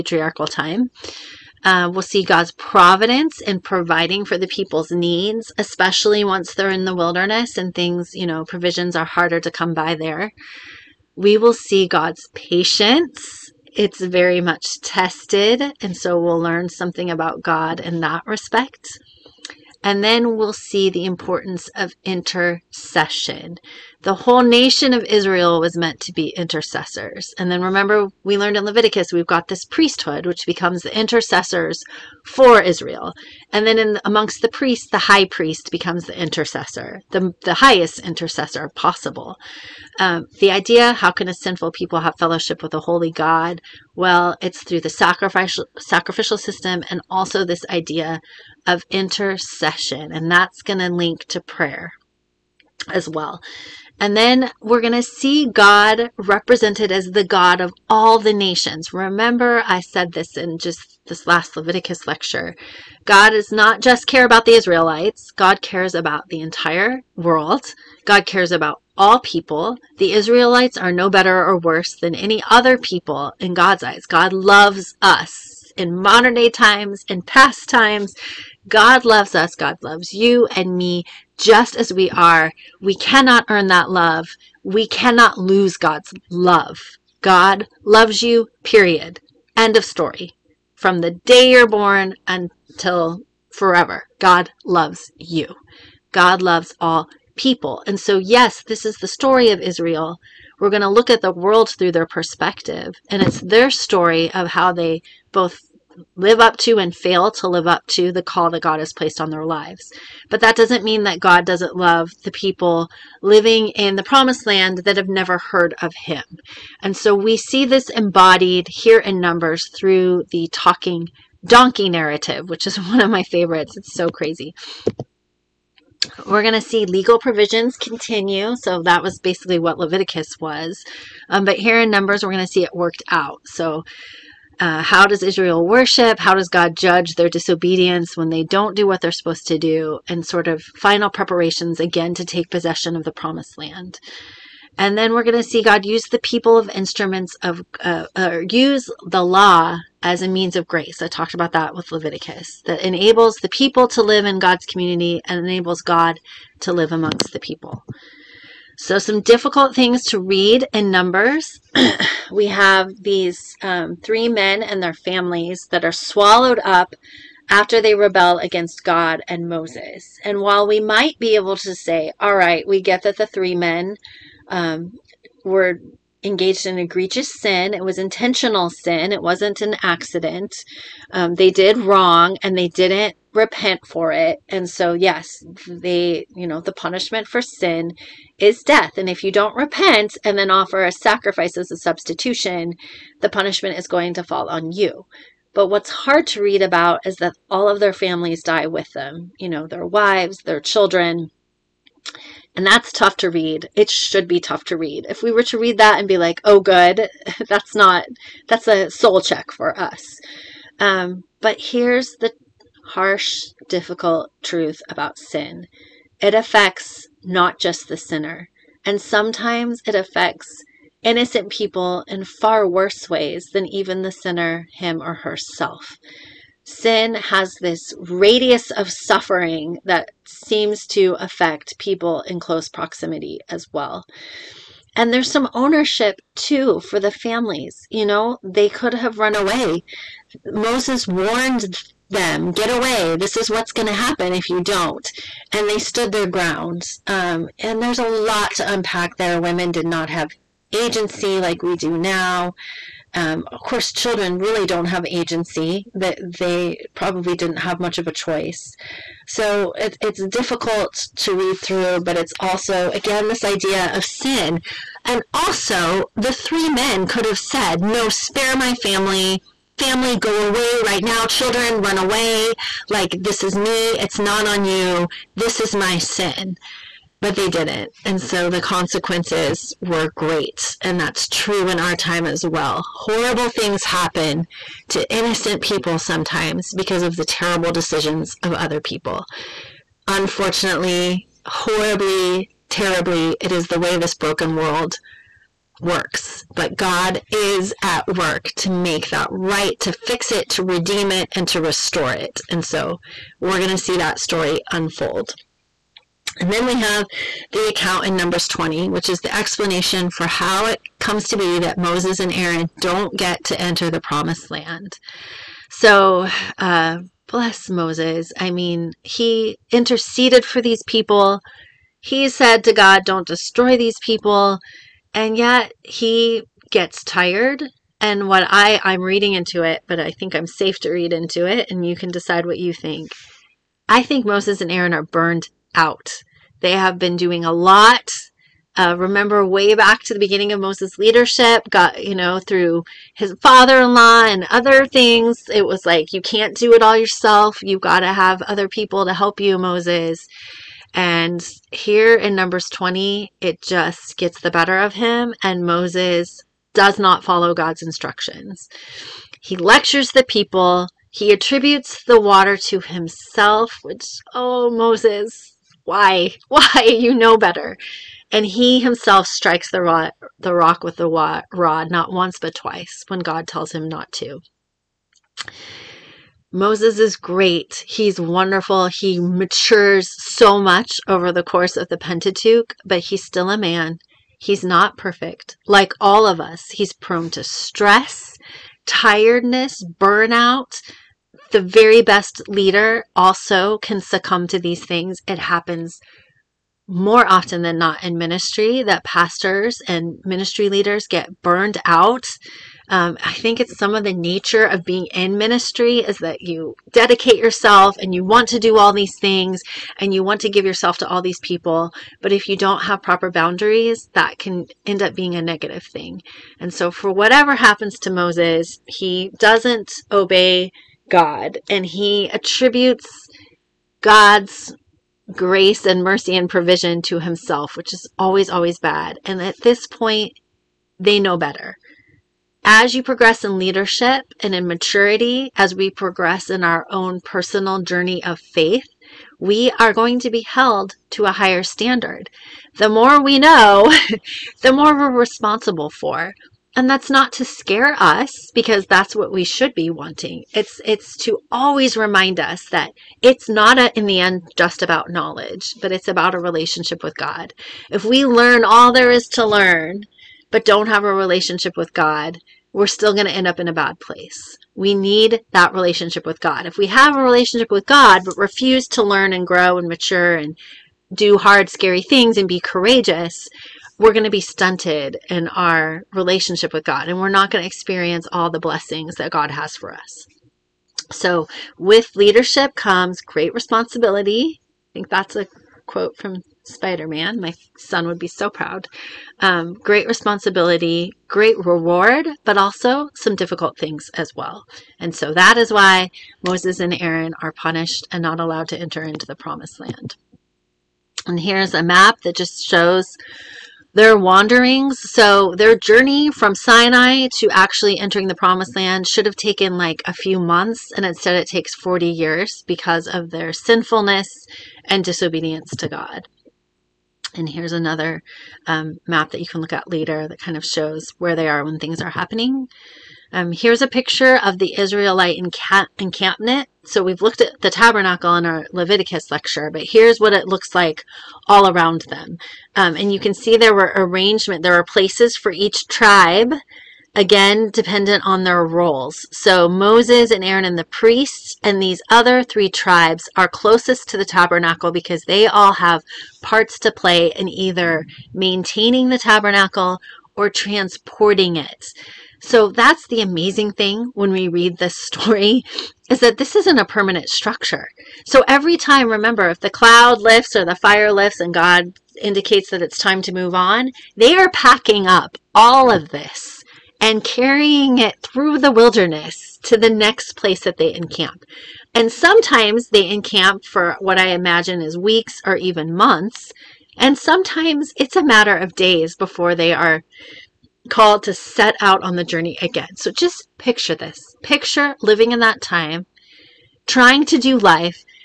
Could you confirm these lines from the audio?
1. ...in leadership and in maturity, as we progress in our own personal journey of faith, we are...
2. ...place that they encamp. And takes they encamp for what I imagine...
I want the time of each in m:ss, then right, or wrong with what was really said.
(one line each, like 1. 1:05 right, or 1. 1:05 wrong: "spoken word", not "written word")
1. 7:13 right
2. 9:30 wrong: "sometimes", not "takes".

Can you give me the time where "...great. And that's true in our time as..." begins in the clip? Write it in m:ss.
4:40.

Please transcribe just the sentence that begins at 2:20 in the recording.
And sort of final preparations again to take possession of the promised land.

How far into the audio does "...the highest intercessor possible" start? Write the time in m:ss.
0:37.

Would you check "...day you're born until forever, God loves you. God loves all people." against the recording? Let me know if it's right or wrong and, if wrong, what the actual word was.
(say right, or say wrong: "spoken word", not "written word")
right.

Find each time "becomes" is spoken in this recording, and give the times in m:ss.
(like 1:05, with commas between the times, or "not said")
0:30, 0:35.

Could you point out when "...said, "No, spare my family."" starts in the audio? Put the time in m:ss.
4:27.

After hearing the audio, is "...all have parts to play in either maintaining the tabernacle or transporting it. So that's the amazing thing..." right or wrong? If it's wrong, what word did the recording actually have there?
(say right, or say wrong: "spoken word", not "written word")
right.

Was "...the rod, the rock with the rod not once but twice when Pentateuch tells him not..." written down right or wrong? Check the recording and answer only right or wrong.
wrong.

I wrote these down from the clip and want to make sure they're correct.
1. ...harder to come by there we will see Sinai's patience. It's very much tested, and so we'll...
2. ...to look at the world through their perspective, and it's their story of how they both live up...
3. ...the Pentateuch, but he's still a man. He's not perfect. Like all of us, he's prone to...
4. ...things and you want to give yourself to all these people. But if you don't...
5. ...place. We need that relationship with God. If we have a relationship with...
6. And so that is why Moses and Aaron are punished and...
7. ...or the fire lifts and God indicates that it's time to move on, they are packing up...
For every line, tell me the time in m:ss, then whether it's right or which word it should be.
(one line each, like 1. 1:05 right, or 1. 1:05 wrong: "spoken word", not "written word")
1. 0:09 wrong: "God", not "Sinai"
2. 1:40 right
3. 6:21 right
4. 6:49 right
5. 7:43 right
6. 8:14 right
7. 9:20 right.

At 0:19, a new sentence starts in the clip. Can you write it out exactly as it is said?
And then we'll see the importance of intercession.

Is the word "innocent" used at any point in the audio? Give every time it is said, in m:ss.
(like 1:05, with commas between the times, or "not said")
3:41, 4:45.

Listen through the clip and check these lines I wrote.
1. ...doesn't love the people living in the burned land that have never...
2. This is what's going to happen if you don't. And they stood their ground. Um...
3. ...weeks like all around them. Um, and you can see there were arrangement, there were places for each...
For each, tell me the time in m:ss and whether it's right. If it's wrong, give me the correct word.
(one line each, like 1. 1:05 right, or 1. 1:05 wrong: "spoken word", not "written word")
1. 1:51 wrong: "promised", not "burned"
2. 4:03 right
3. 8:50 wrong: "looks", not "weeks".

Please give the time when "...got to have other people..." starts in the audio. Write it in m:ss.
5:47.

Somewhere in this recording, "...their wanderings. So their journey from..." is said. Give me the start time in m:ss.
8:23.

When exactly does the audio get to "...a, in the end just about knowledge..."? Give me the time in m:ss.
7:33.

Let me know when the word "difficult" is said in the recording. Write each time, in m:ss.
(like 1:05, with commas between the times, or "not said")
2:39, 3:33, 4:20, 8:13.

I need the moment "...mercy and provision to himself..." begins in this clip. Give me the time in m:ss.
7:06.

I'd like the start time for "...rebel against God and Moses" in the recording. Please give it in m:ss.
2:47.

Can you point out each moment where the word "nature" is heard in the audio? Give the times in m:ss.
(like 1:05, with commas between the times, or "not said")
6:44.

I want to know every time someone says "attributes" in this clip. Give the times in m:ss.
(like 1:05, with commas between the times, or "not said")
6:01, 7:02.